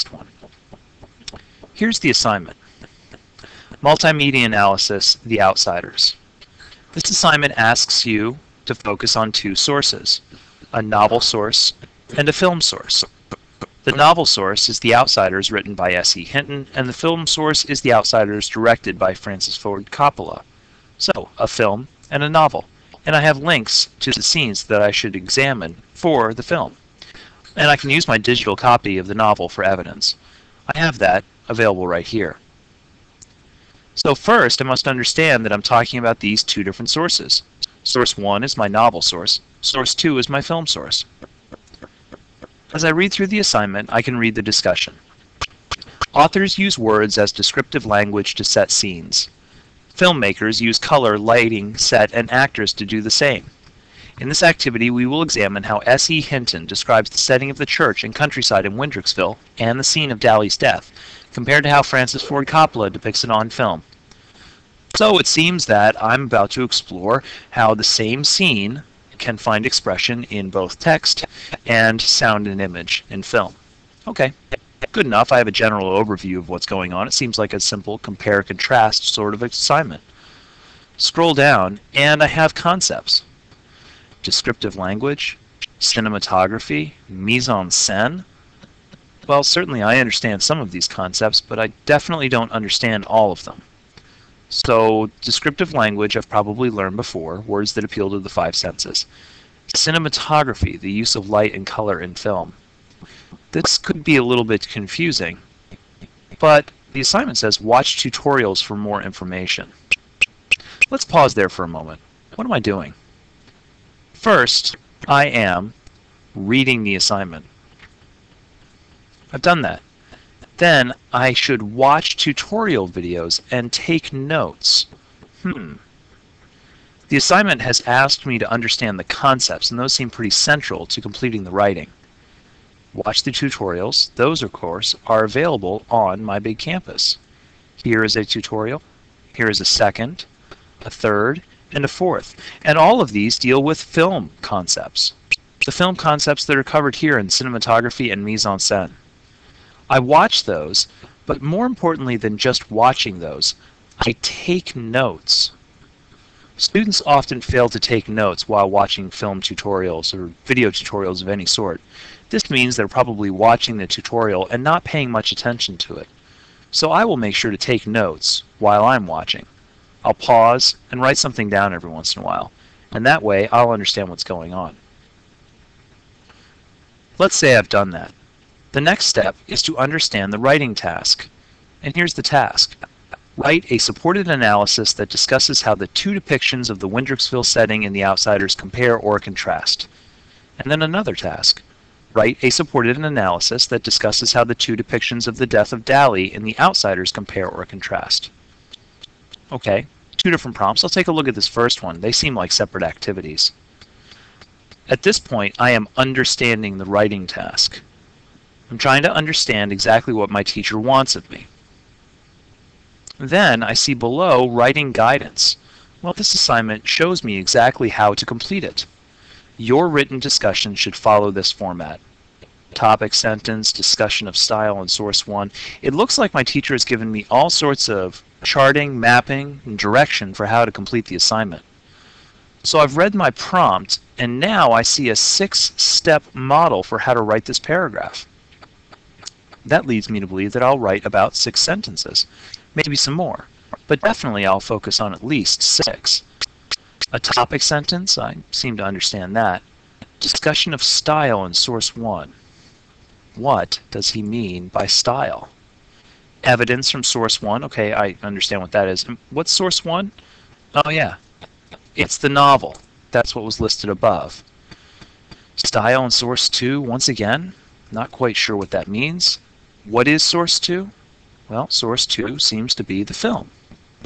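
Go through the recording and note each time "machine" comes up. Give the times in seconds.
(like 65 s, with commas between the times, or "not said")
not said.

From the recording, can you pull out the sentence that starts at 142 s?
And all of these deal with film concepts.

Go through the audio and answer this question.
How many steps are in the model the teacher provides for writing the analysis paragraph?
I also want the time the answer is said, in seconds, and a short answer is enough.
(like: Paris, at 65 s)
6, at 235 s.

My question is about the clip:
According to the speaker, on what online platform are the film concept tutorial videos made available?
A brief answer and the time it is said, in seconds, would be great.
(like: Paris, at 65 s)
My Big Campus, at 136 s.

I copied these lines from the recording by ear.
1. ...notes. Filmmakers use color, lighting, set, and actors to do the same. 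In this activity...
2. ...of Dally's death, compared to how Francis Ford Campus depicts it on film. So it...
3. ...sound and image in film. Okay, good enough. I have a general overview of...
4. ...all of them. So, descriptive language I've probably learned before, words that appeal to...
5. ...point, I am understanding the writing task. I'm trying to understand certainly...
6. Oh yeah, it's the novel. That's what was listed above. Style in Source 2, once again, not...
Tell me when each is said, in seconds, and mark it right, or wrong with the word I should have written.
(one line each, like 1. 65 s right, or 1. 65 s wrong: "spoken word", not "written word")
1. 48 s wrong: "scenes", not "notes"
2. 60 s wrong: "Coppola", not "Campus"
3. 71 s right
4. 93 s right
5. 205 s wrong: "exactly", not "certainly"
6. 260 s right.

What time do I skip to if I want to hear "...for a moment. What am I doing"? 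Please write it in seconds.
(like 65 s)
111 s.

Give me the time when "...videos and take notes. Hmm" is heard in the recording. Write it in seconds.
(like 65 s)
122 s.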